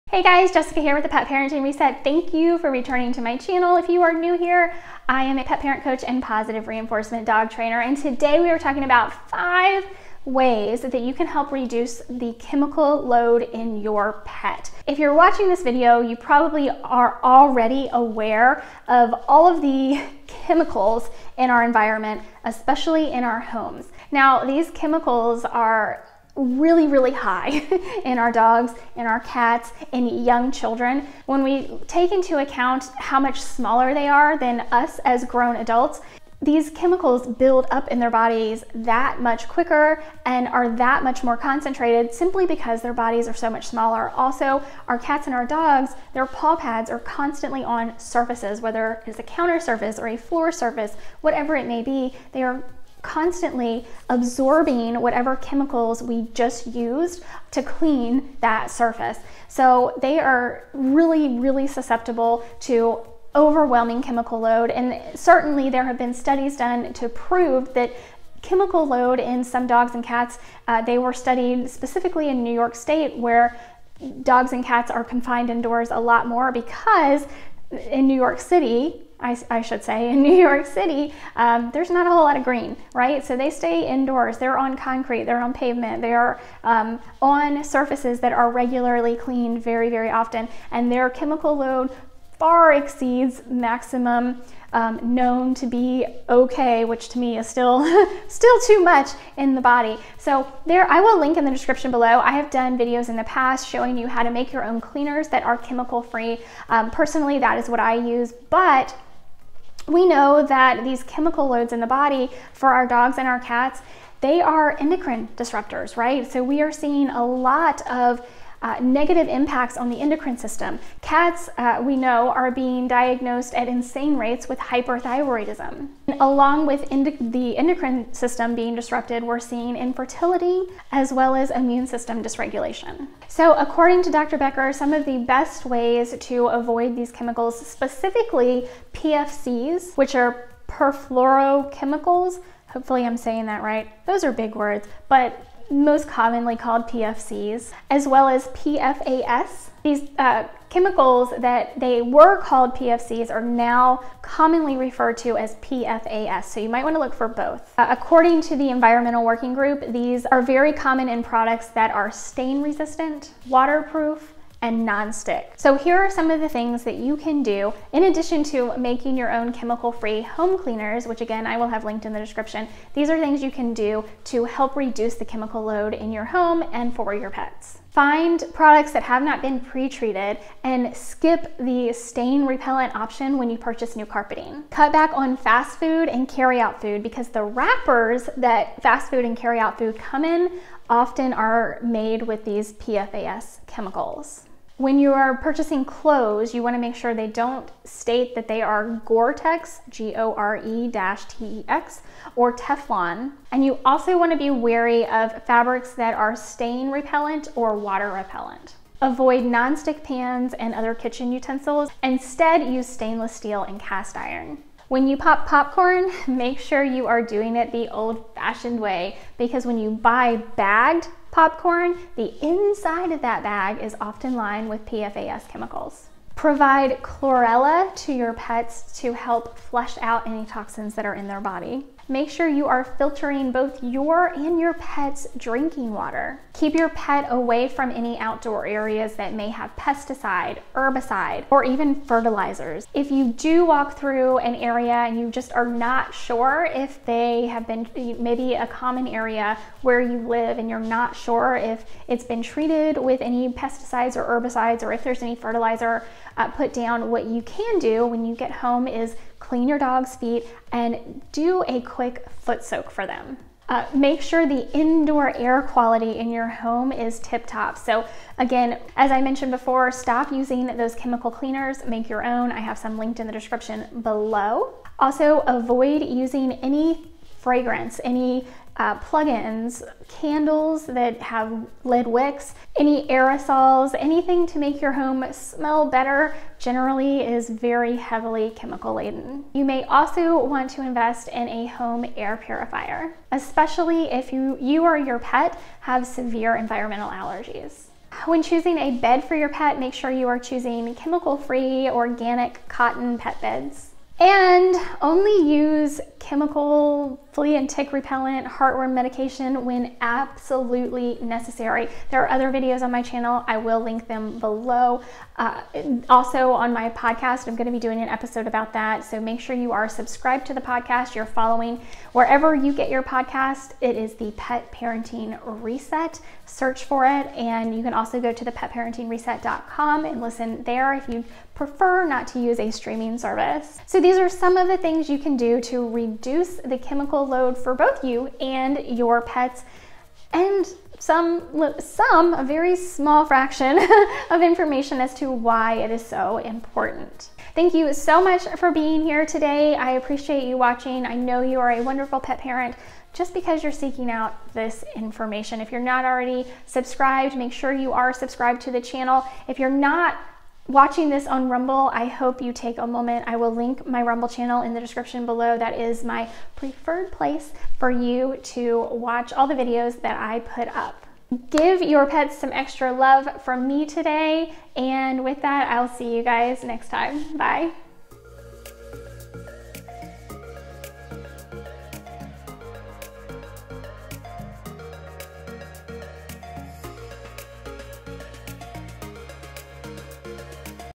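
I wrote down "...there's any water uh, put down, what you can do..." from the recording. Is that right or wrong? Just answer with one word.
wrong.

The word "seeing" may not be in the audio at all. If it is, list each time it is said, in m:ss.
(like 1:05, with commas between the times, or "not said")
1:56, 2:09.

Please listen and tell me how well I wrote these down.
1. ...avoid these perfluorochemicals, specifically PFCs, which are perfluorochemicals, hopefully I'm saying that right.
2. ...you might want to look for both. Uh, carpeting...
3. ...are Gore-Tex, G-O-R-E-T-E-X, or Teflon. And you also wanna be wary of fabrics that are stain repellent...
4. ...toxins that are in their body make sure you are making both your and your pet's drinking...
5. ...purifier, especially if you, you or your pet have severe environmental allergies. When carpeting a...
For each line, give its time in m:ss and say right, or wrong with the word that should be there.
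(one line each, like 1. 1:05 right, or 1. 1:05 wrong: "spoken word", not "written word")
1. 2:16 wrong: "chemicals", not "perfluorochemicals"
2. 2:36 wrong: "according", not "carpeting"
3. 3:18 right
4. 3:50 wrong: "filtering", not "making"
5. 4:52 wrong: "choosing", not "carpeting".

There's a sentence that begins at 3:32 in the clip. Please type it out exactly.
Instead, use stainless steel and cast iron.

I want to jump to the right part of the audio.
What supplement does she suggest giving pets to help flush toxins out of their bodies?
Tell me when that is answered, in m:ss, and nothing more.
3:47.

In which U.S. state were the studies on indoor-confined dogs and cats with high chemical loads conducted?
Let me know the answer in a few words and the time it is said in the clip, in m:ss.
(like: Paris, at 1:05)
New York State, at 1:12.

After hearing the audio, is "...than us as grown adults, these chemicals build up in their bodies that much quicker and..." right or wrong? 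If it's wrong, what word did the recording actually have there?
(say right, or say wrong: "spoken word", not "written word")
right.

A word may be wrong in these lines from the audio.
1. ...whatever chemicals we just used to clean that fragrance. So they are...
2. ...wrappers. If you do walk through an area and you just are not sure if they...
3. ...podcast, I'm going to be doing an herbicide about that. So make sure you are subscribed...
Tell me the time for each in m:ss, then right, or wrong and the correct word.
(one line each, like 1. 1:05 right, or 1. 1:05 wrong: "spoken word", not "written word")
1. 0:55 wrong: "surface", not "fragrance"
2. 4:02 wrong: "fertilizers", not "wrappers"
3. 5:16 wrong: "episode", not "herbicide".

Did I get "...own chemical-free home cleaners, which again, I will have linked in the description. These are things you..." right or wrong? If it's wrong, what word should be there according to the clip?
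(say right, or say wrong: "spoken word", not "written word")
right.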